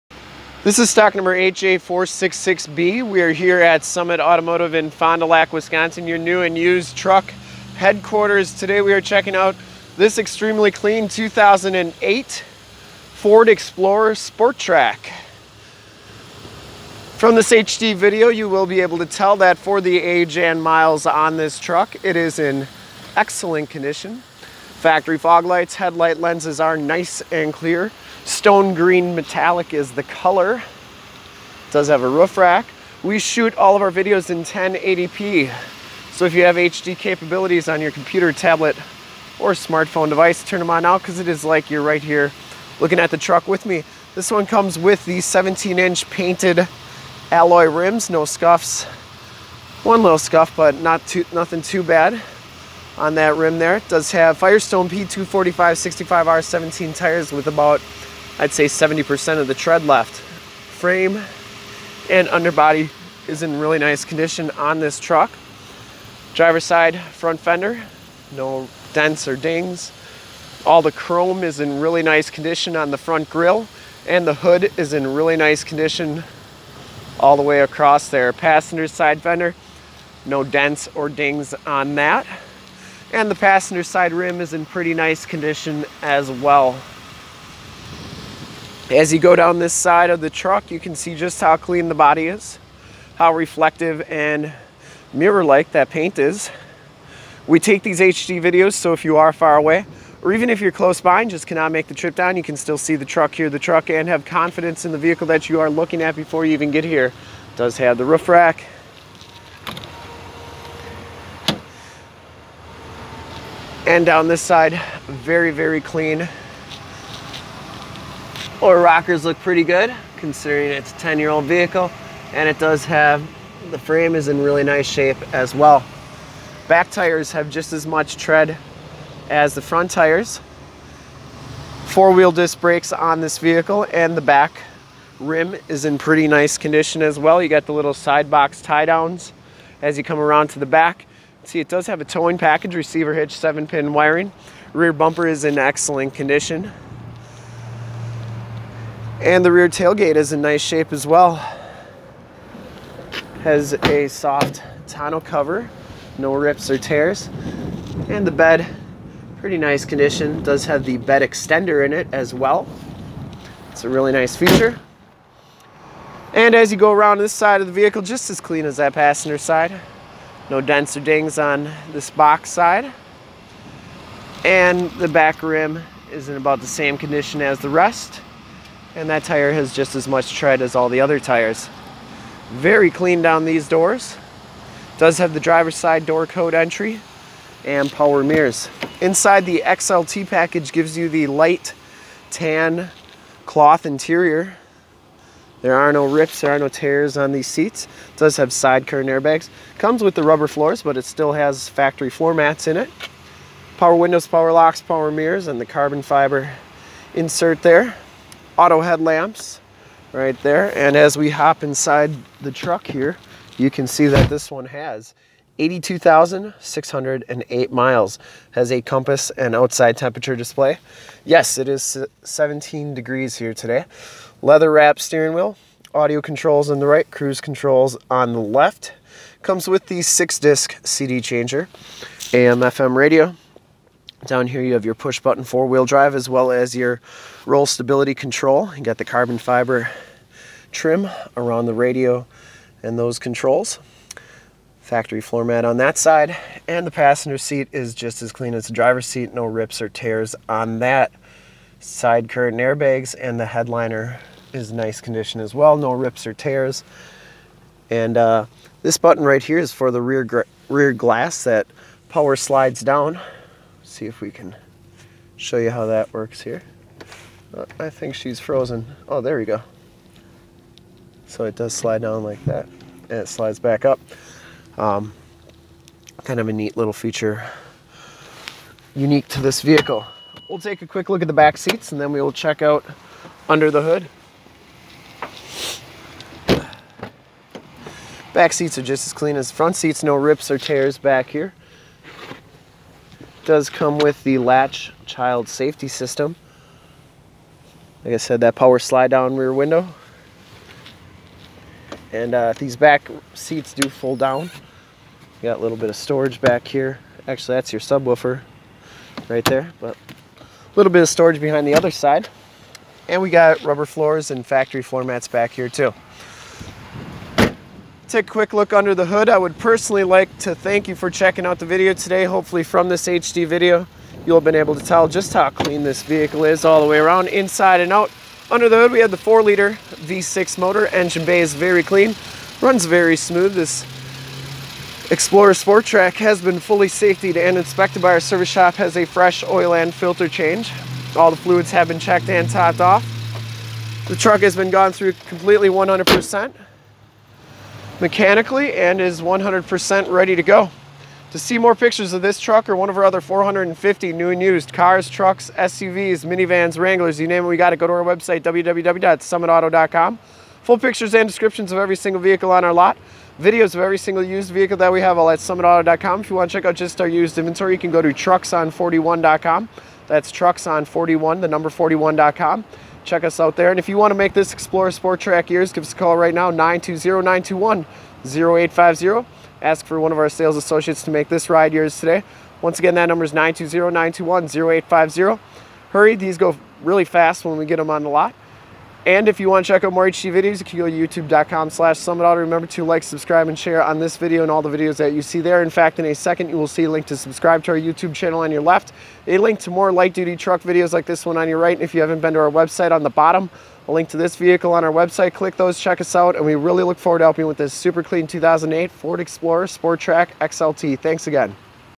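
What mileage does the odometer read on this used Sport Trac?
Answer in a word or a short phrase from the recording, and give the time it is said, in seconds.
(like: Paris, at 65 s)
82,608, at 215 s.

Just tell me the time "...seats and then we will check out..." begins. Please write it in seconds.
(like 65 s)
281 s.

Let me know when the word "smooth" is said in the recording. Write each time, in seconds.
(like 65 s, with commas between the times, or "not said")
333 s.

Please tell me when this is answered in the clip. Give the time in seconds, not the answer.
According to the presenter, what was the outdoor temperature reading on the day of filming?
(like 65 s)
222 s.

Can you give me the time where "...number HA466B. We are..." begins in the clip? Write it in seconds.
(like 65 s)
1 s.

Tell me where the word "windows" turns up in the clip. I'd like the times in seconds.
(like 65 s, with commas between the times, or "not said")
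203 s, 299 s.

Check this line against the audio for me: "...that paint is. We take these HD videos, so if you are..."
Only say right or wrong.
right.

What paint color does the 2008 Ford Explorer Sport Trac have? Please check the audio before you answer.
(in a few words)
Stone green metallic.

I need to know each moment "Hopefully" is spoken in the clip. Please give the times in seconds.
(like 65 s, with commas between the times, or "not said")
322 s.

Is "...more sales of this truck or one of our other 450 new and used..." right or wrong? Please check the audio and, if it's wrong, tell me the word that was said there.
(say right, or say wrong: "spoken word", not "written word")
wrong: "pictures", not "sales".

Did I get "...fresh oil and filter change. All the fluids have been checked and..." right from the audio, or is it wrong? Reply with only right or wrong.
right.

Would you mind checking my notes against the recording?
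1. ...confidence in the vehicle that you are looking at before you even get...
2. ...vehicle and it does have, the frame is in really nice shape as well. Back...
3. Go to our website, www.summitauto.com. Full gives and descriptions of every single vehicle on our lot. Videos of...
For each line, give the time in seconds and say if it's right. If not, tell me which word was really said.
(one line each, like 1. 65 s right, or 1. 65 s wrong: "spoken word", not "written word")
1. 104 s right
2. 121 s right
3. 357 s wrong: "pictures", not "gives".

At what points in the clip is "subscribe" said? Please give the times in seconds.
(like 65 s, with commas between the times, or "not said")
393 s, 397 s.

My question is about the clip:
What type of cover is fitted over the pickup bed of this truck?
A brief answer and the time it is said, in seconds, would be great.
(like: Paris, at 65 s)
Soft tonneau cover, at 154 s.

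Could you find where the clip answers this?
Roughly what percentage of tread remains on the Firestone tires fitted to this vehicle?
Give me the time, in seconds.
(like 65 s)
58 s.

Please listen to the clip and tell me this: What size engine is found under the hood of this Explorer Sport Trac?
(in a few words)
4-liter V6.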